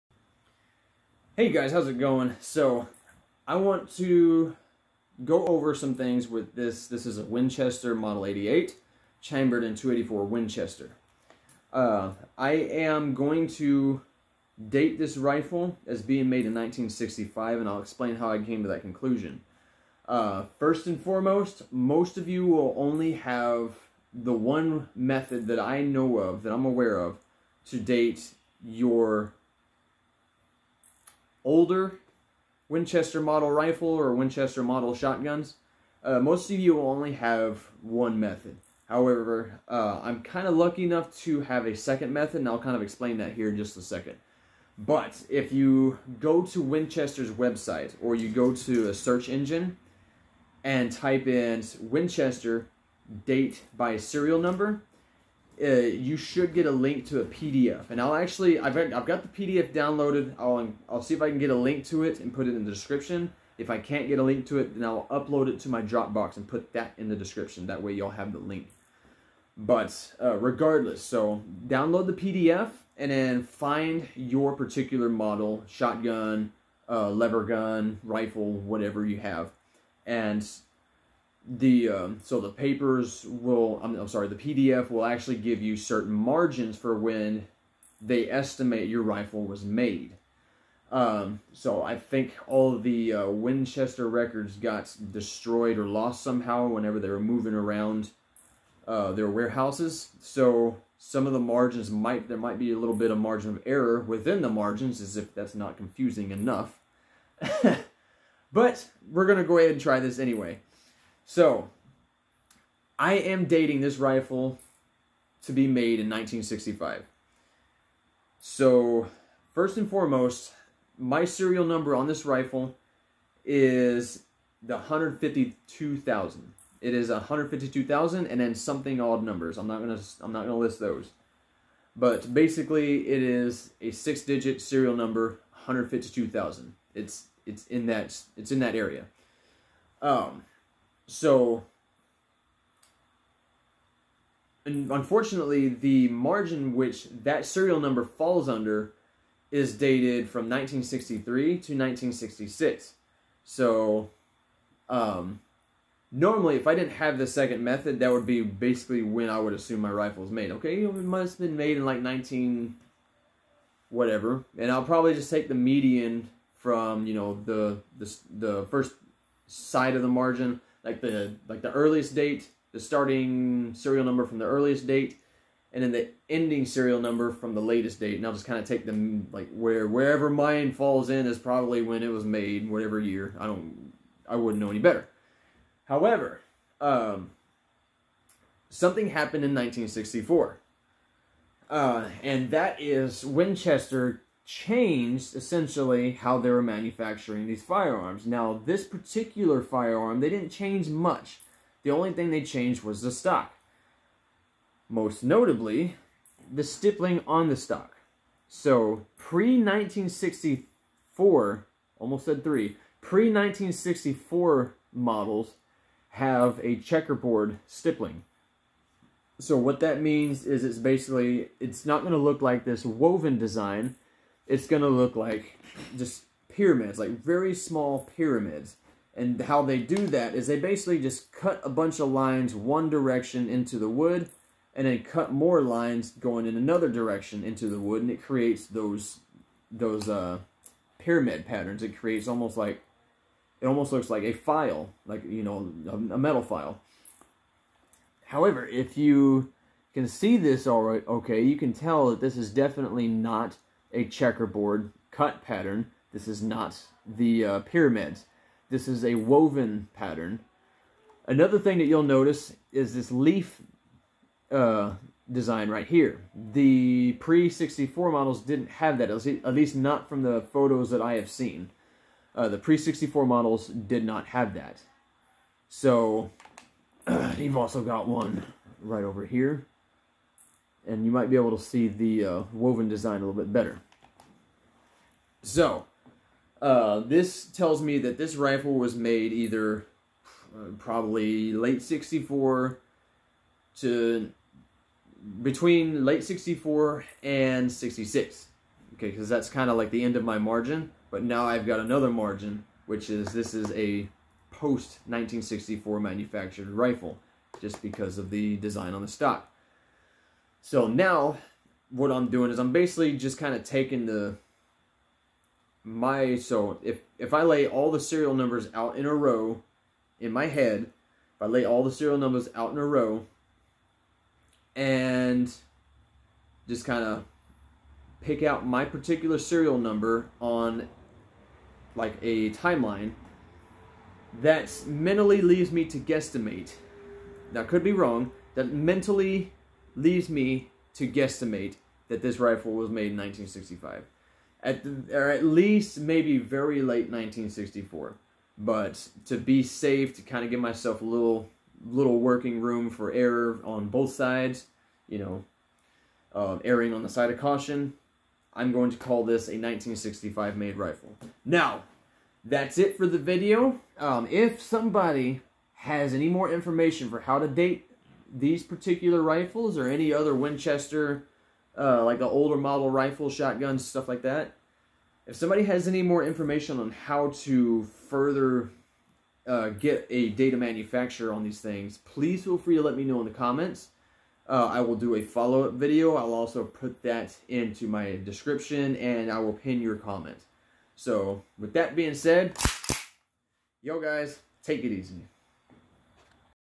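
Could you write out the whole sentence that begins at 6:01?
Now, that's it for the video.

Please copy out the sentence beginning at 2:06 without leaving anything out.
It is 152,000 and then something odd numbers.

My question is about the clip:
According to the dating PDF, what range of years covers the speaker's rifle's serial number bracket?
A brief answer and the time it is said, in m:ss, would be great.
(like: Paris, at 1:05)
1963 to 1966, at 2:30.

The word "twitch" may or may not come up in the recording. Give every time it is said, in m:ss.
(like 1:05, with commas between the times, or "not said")
not said.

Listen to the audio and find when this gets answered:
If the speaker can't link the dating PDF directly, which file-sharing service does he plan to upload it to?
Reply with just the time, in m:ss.
1:05.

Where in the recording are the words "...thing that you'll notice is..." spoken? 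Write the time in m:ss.
4:21.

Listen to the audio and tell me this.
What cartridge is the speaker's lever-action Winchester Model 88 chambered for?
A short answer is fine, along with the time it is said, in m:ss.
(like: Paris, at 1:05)
284 Winchester, at 0:09.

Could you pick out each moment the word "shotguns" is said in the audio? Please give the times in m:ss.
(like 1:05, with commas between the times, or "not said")
0:34, 1:15, 6:13.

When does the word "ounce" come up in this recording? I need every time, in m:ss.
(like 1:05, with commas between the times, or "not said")
not said.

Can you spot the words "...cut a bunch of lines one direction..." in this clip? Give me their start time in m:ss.
3:51.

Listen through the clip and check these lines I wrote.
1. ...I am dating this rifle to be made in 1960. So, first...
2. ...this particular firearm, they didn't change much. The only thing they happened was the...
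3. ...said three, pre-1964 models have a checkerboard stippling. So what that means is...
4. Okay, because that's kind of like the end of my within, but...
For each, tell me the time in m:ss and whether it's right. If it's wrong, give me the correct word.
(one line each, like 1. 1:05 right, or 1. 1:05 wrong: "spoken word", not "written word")
1. 1:52 wrong: "1965", not "1960"
2. 3:18 wrong: "changed", not "happened"
3. 3:32 right
4. 4:58 wrong: "margin", not "within".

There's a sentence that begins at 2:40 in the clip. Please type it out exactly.
Okay, it must have been made in like 19, whatever.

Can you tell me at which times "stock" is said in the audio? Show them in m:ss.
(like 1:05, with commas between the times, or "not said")
3:23, 3:27, 5:09.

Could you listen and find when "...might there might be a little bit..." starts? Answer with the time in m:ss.
1:41.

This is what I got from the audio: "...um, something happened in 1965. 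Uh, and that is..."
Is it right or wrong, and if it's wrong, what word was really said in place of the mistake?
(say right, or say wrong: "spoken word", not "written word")
wrong: "1964", not "1965".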